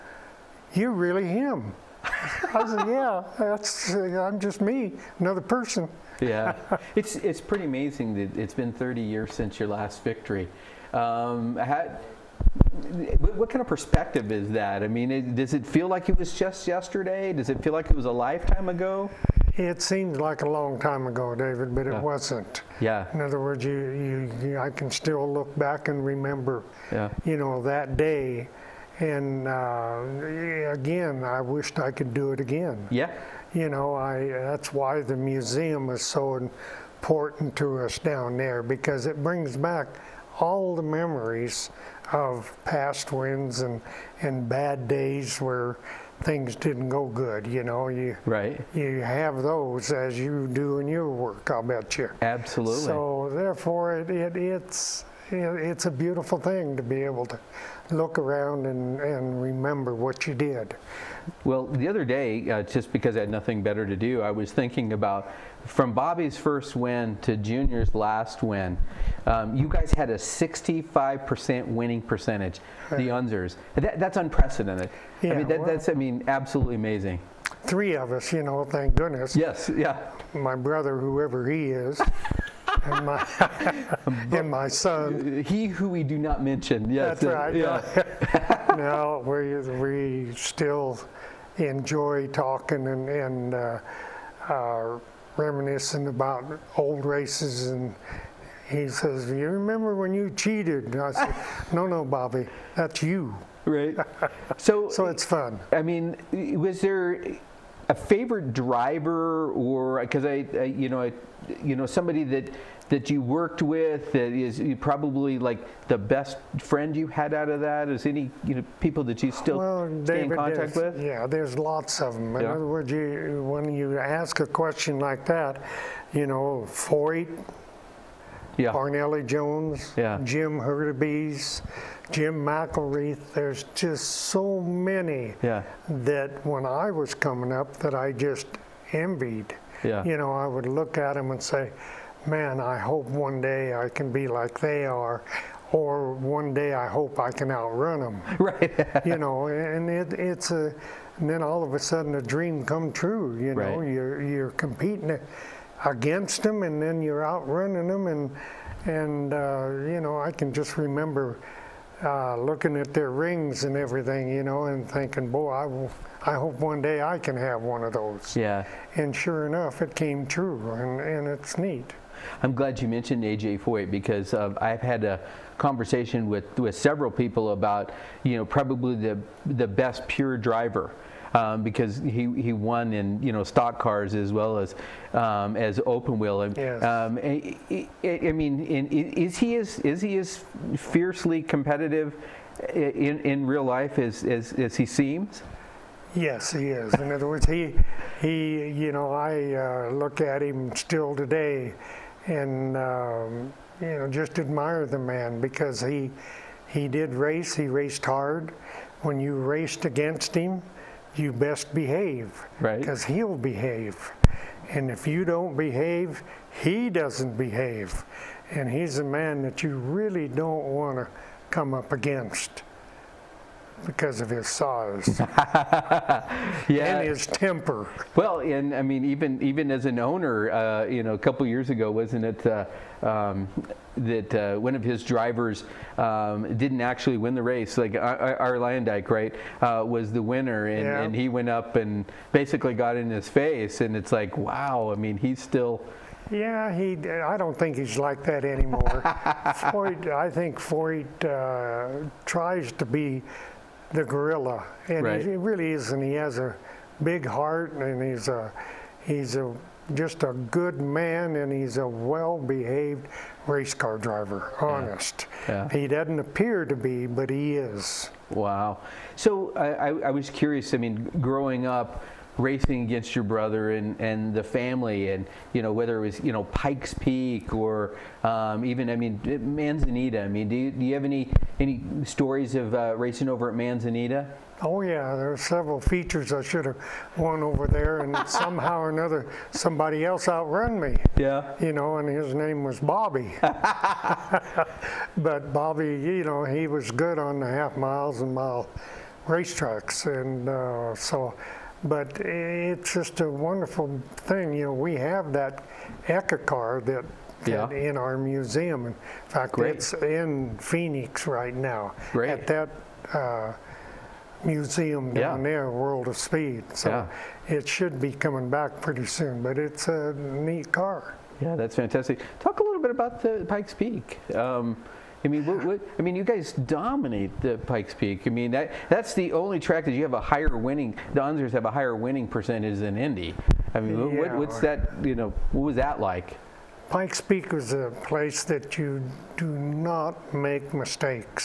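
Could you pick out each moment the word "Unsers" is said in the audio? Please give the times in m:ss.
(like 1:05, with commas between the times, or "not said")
1:13, 5:31.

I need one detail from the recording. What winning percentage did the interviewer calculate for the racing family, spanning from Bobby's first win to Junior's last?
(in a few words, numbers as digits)
65%.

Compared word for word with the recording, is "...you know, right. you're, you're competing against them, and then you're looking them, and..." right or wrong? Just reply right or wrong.
wrong.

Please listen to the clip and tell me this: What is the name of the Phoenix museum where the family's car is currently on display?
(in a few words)
World of Speed.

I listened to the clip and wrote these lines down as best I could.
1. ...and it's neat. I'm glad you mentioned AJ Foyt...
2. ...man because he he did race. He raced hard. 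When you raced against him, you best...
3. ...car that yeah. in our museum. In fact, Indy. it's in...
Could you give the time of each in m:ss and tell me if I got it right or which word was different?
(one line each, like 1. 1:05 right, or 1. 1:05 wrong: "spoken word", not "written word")
1. 2:50 right
2. 3:24 right
3. 5:06 wrong: "Great", not "Indy".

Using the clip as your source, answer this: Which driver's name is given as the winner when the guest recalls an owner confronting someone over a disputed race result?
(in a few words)
Luyendyk.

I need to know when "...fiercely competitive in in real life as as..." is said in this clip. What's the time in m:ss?
3:10.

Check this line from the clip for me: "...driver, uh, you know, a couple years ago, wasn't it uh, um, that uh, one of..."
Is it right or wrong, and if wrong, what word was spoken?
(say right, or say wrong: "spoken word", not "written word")
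wrong: "owner", not "driver".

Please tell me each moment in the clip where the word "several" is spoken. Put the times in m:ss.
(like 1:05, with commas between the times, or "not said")
2:56, 4:45.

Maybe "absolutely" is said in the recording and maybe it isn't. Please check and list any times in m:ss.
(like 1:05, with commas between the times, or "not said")
0:52, 1:16.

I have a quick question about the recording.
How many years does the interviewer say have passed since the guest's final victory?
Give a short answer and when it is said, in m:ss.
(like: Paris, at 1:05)
30, at 0:08.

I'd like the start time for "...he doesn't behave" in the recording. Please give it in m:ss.
3:36.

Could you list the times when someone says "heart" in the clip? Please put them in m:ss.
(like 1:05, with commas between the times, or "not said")
4:17.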